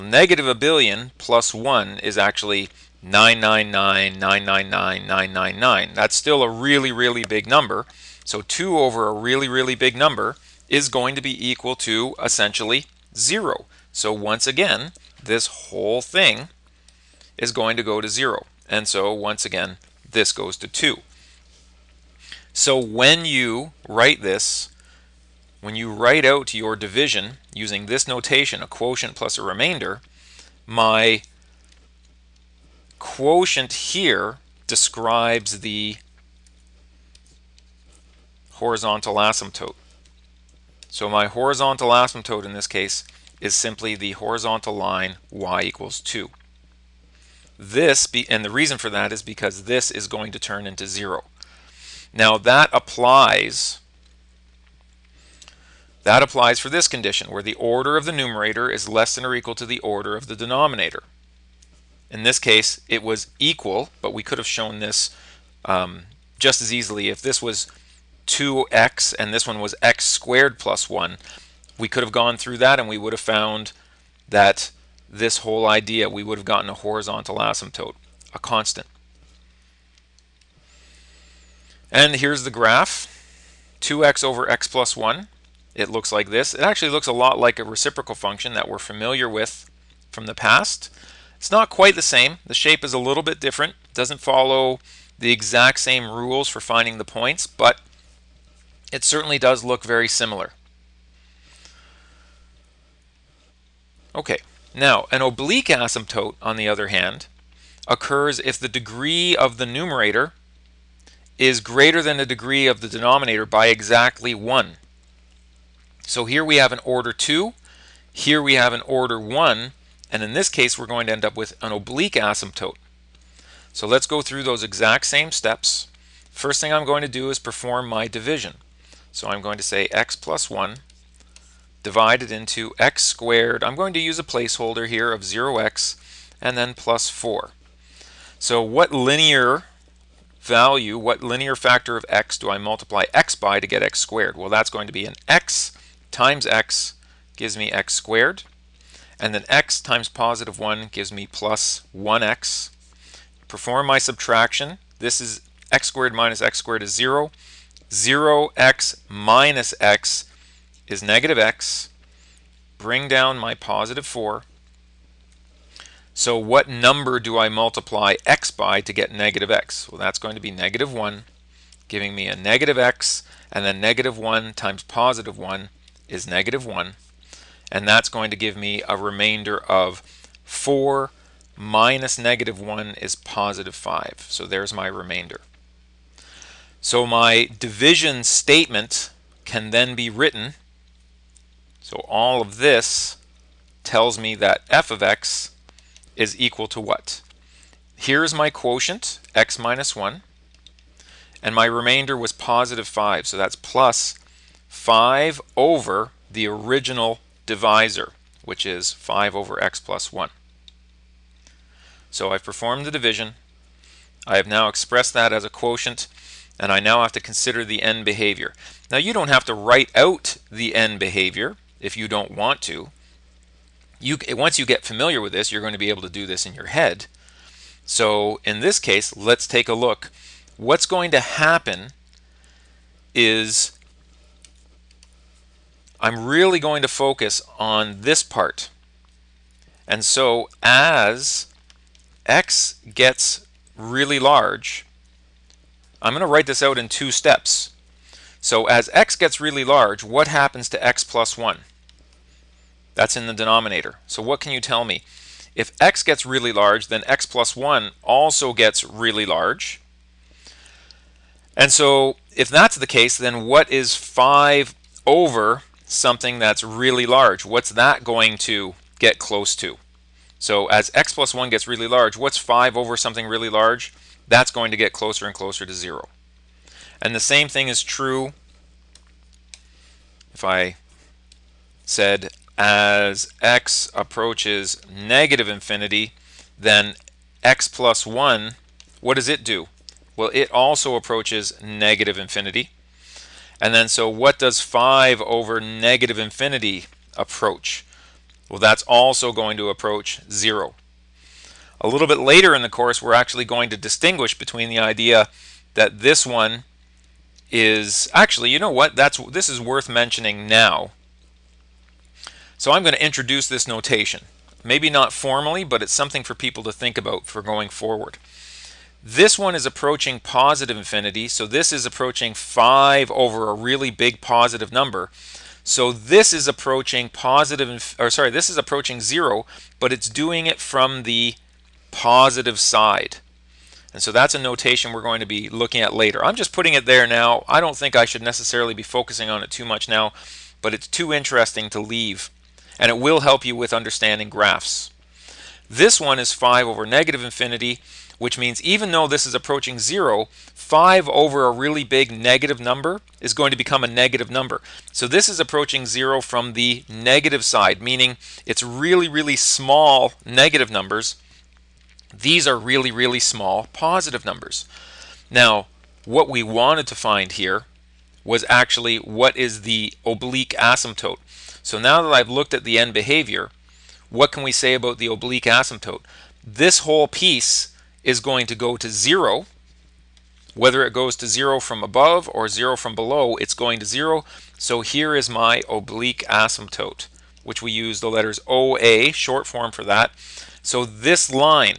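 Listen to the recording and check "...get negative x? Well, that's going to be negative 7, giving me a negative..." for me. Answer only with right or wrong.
wrong.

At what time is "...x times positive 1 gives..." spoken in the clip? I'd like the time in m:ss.
2:29.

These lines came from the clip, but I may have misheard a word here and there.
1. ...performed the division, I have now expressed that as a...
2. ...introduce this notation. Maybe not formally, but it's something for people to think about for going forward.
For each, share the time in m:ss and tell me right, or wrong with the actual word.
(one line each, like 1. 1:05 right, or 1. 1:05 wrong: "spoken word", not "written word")
1. 3:32 right
2. 5:13 right.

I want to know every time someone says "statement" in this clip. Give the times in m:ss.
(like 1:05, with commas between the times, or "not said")
3:08.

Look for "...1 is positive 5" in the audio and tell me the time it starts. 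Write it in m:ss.
3:02.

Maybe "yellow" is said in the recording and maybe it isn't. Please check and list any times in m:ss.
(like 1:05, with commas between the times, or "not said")
not said.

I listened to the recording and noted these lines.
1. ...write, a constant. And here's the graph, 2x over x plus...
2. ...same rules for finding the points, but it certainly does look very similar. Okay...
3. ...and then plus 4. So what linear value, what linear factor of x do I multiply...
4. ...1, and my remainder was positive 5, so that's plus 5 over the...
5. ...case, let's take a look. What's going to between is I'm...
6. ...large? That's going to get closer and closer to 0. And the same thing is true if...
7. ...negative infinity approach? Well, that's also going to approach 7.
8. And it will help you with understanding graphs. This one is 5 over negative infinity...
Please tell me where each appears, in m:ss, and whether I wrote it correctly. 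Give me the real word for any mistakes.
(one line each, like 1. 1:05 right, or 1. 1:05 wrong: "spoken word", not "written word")
1. 1:17 wrong: "asymptote", not "write"
2. 1:35 right
3. 2:16 right
4. 3:19 right
5. 3:48 wrong: "happen", not "between"
6. 4:33 right
7. 4:55 wrong: "0", not "7"
8. 5:42 right.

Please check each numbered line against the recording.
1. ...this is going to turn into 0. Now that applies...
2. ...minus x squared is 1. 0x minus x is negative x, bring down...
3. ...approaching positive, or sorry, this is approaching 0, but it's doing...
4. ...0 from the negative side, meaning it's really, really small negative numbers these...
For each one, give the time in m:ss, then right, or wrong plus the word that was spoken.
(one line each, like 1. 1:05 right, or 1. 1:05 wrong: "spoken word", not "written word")
1. 0:49 right
2. 2:36 wrong: "0", not "1"
3. 5:26 right
4. 5:55 right.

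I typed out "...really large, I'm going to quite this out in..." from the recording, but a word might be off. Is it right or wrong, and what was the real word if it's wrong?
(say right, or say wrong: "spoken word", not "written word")
wrong: "write", not "quite".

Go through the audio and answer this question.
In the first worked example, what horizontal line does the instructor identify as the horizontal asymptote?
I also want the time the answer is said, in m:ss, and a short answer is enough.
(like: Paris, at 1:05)
y = 2, at 0:45.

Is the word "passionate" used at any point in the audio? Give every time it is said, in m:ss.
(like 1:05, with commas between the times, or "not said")
not said.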